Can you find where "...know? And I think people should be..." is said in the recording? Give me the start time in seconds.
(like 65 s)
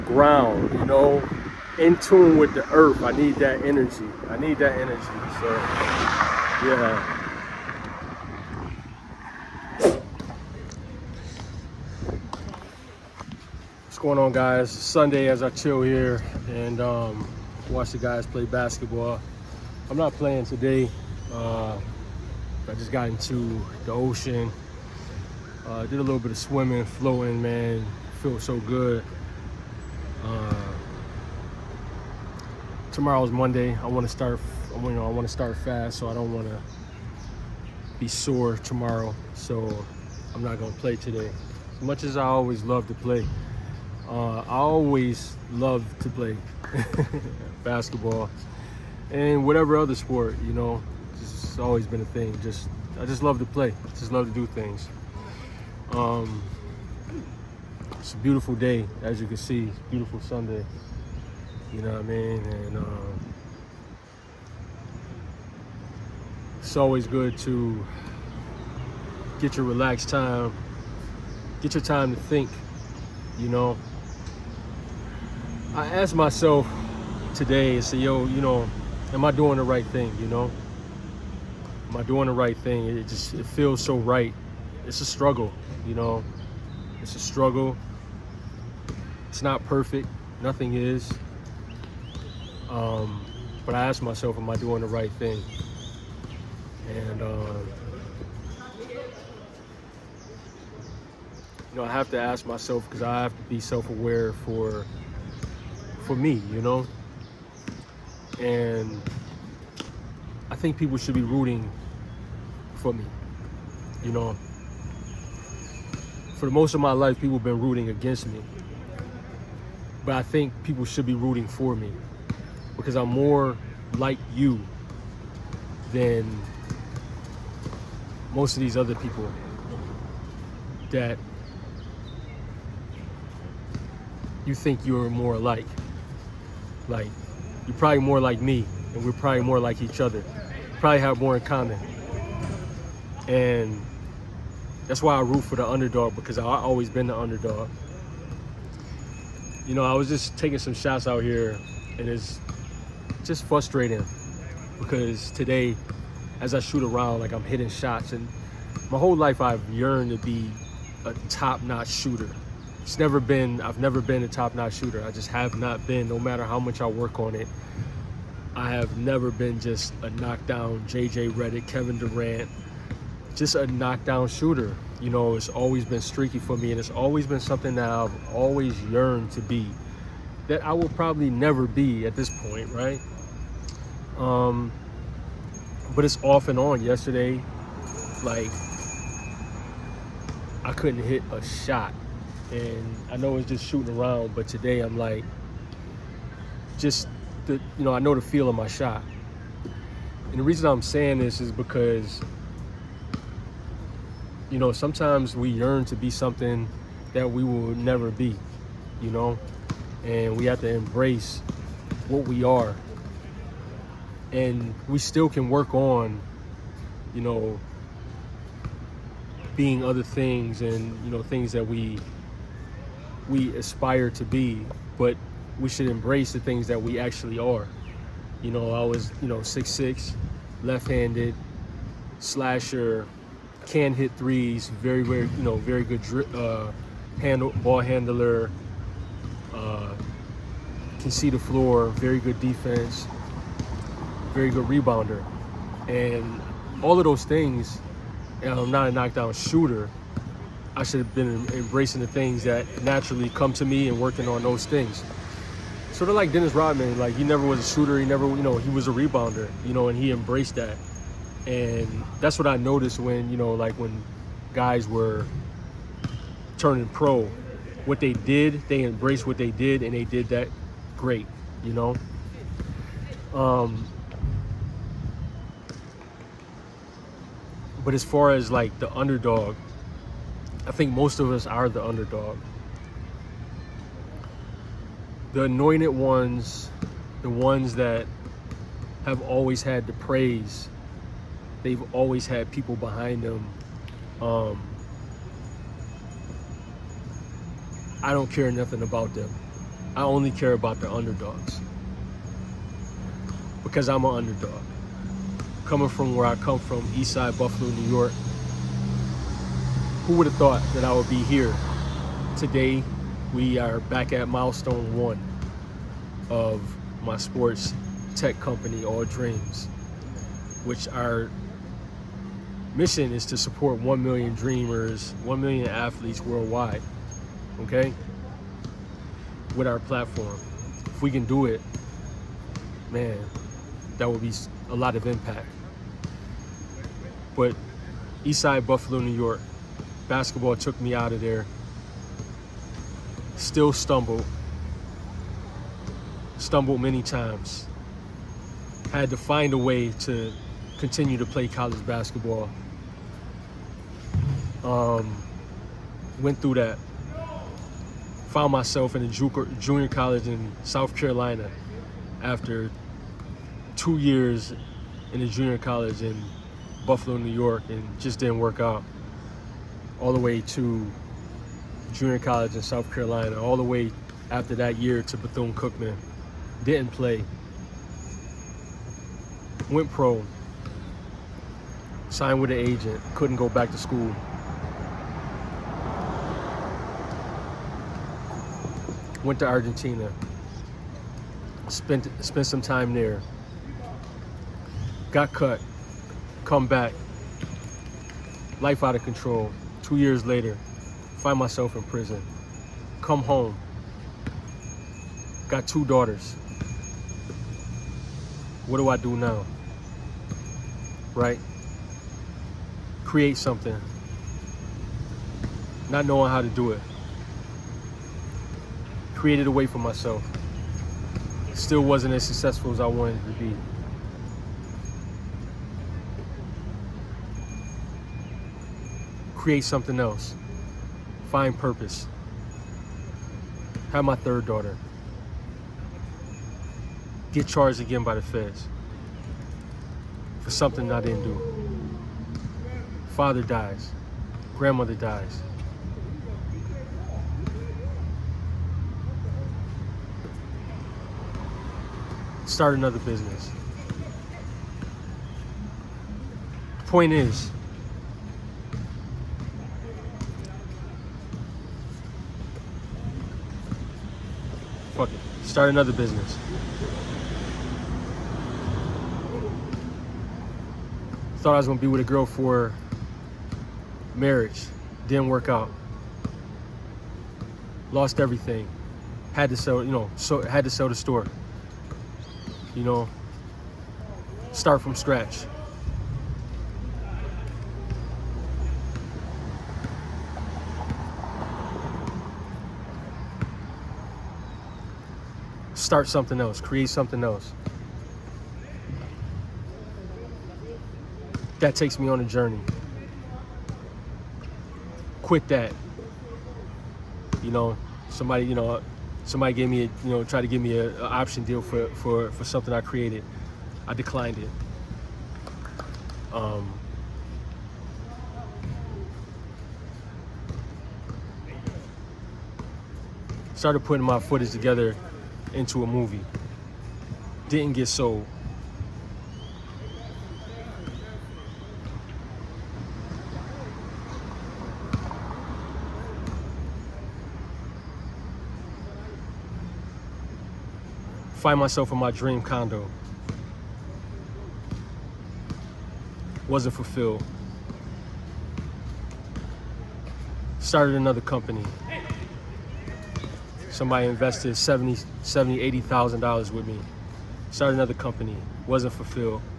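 106 s.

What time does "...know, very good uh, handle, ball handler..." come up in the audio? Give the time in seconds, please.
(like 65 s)
235 s.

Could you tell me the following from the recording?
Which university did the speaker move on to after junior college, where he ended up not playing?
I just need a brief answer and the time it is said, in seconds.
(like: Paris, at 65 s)
Bethune-Cookman, at 375 s.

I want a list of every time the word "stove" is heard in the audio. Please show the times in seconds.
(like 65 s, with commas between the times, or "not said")
not said.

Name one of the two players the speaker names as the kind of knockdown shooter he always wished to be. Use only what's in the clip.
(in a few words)
JJ Redick.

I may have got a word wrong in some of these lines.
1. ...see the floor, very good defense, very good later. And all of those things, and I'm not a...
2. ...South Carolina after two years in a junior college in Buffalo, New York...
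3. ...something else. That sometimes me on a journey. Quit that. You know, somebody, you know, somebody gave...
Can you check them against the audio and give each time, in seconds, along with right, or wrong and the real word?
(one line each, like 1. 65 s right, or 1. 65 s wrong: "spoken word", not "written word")
1. 241 s wrong: "rebounder", not "later"
2. 360 s right
3. 496 s wrong: "takes", not "sometimes".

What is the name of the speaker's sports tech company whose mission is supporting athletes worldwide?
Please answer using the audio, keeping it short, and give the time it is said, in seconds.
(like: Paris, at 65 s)
All Dreams, at 318 s.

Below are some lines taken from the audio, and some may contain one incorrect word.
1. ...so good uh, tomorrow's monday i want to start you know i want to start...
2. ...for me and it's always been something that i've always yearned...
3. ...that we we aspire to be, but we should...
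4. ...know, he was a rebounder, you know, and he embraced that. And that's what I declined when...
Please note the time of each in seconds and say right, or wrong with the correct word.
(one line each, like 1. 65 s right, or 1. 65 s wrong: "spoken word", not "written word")
1. 28 s right
2. 176 s right
3. 221 s right
4. 258 s wrong: "noticed", not "declined".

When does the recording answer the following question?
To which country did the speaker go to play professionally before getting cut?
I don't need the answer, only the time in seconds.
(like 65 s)
389 s.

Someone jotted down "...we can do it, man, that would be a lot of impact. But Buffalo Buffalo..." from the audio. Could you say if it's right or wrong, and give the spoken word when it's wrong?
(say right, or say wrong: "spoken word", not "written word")
wrong: "Eastside", not "Buffalo".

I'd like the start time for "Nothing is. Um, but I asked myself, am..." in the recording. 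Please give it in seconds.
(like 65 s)
90 s.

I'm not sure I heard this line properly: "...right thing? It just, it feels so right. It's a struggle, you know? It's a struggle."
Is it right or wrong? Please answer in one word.
right.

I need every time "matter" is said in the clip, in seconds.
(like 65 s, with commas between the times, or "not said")
166 s.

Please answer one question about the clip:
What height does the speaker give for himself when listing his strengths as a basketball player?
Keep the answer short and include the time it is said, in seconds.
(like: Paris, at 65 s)
6'6", at 229 s.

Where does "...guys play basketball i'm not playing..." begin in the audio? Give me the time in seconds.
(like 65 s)
17 s.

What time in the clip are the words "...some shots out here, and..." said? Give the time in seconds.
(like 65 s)
150 s.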